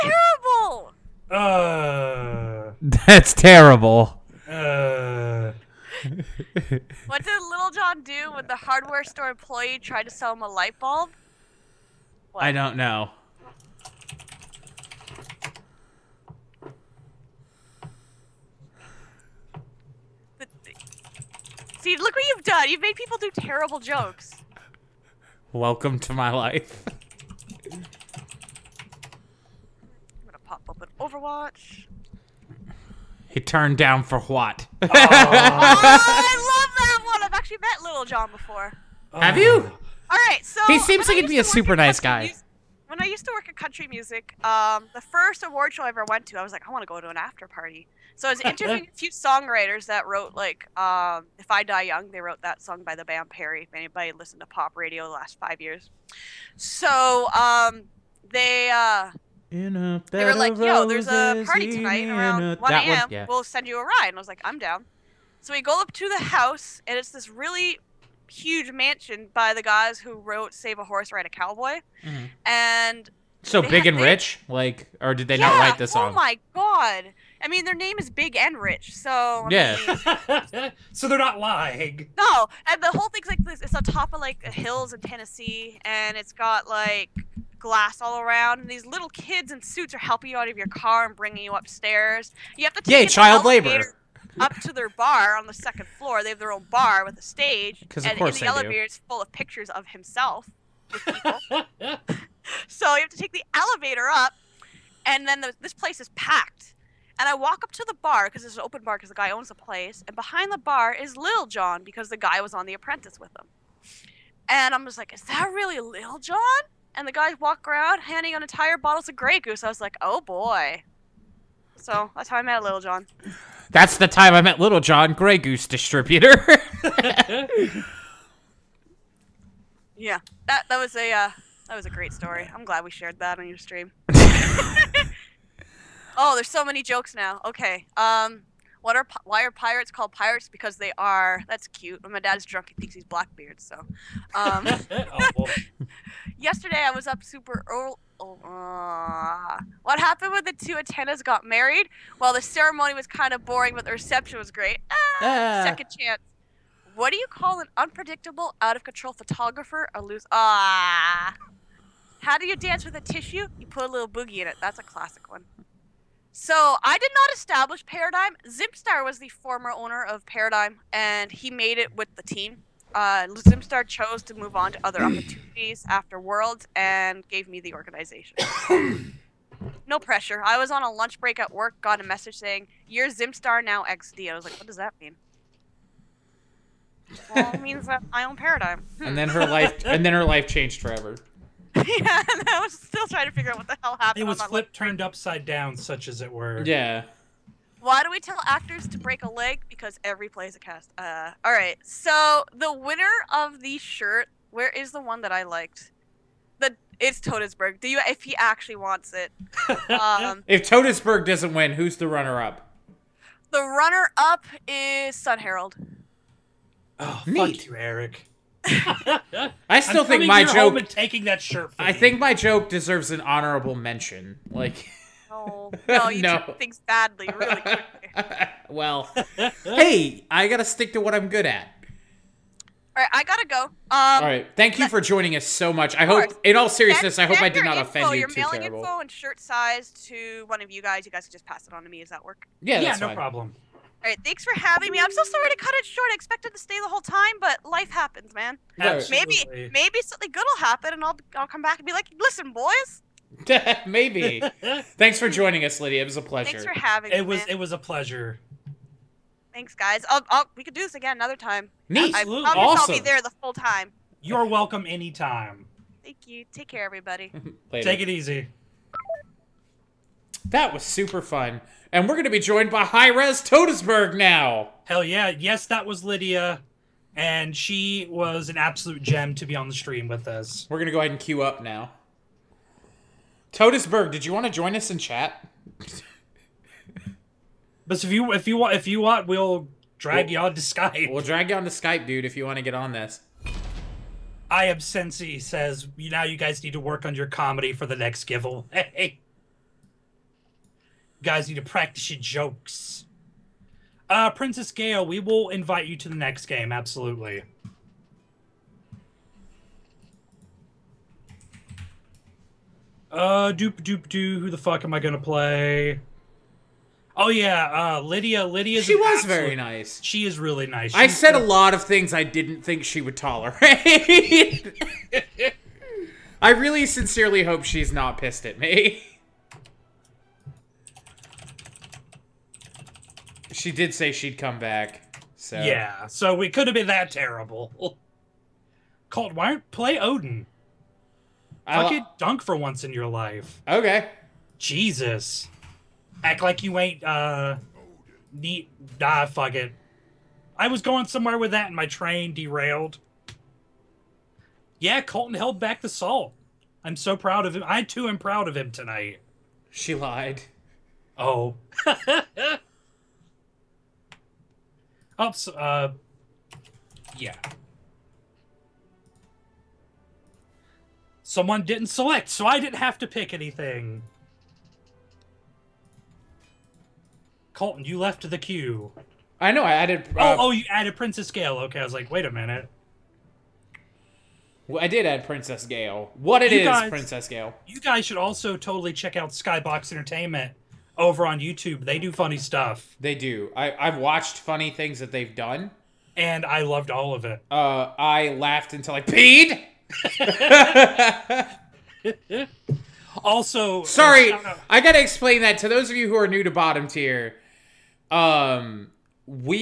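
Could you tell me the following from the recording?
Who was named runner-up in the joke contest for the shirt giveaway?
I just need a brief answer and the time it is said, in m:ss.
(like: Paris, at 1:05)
Sun Herald, at 3:35.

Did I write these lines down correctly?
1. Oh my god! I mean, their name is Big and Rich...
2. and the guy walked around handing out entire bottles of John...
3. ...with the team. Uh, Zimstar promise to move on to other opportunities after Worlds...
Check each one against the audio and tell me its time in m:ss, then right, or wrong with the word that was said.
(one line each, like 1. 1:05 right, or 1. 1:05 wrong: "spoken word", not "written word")
1. 1:16 right
2. 1:56 wrong: "Grey", not "John"
3. 2:51 wrong: "chose", not "promise".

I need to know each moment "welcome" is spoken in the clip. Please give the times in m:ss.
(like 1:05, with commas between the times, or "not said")
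0:25, 4:24.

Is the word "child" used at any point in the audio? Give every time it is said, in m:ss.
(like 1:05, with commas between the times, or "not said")
1:33.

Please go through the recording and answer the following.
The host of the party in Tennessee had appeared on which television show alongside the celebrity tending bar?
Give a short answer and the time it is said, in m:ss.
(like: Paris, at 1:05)
The Apprentice, at 1:52.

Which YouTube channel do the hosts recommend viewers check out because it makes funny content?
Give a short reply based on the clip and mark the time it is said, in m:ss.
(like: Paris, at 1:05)
Skybox Entertainment, at 6:29.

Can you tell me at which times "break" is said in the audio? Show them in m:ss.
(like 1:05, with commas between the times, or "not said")
3:01, 3:18.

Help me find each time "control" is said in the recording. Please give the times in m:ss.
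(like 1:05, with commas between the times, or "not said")
2:38.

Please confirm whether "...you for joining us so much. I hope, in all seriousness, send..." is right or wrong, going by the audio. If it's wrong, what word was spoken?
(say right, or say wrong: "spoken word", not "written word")
right.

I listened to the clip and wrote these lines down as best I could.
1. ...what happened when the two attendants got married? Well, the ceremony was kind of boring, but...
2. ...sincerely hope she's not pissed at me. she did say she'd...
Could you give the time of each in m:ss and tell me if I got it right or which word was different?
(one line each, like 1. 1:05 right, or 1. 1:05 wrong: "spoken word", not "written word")
1. 2:29 right
2. 5:26 right.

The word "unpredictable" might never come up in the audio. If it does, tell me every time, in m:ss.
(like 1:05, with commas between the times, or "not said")
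2:37.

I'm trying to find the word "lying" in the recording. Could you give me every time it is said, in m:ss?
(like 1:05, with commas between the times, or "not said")
1:21.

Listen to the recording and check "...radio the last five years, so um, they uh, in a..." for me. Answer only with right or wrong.
right.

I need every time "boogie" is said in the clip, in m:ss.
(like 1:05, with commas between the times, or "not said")
2:44.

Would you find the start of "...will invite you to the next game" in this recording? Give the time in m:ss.
5:05.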